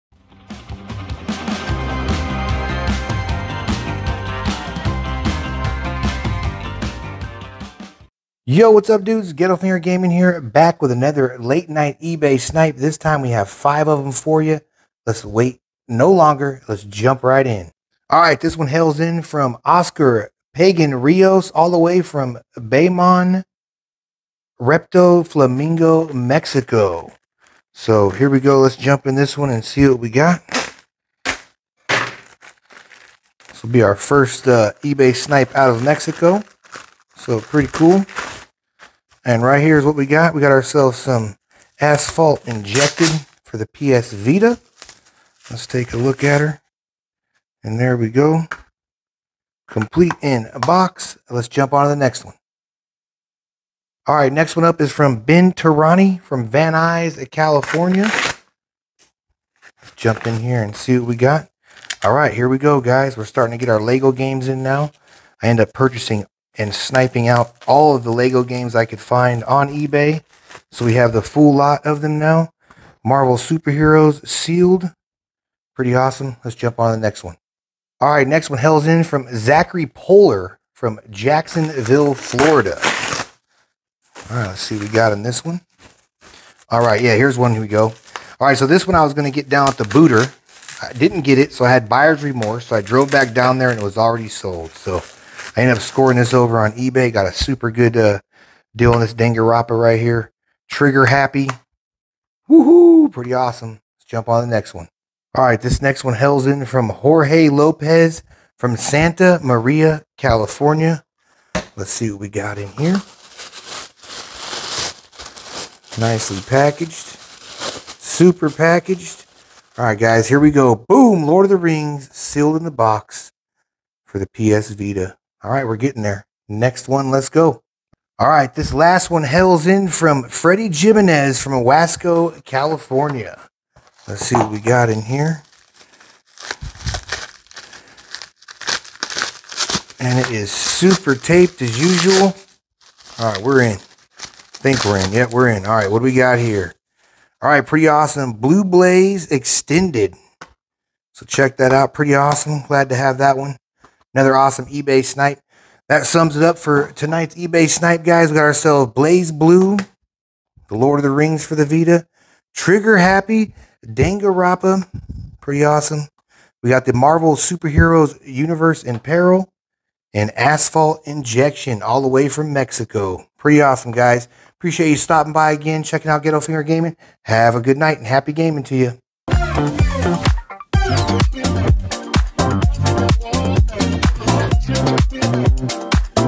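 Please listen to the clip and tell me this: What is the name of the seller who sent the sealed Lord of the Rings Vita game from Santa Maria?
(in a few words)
Jorge Lopez.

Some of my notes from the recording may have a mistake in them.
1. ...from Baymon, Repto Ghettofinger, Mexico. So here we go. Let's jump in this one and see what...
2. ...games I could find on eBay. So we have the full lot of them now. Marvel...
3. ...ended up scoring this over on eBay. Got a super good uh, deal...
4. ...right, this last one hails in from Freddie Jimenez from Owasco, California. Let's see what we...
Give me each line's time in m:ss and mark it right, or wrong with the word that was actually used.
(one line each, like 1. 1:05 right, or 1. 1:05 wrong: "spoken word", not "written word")
1. 0:22 wrong: "Flamingo", not "Ghettofinger"
2. 1:08 right
3. 1:35 right
4. 2:08 right.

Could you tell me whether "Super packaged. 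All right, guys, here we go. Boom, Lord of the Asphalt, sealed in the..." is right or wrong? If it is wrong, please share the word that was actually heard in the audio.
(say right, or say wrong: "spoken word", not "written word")
wrong: "Rings", not "Asphalt".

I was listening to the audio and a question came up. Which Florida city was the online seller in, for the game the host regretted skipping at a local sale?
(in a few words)
Jacksonville.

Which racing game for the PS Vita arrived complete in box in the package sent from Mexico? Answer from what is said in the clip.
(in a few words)
Asphalt Injection.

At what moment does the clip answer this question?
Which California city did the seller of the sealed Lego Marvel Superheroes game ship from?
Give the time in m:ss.
0:56.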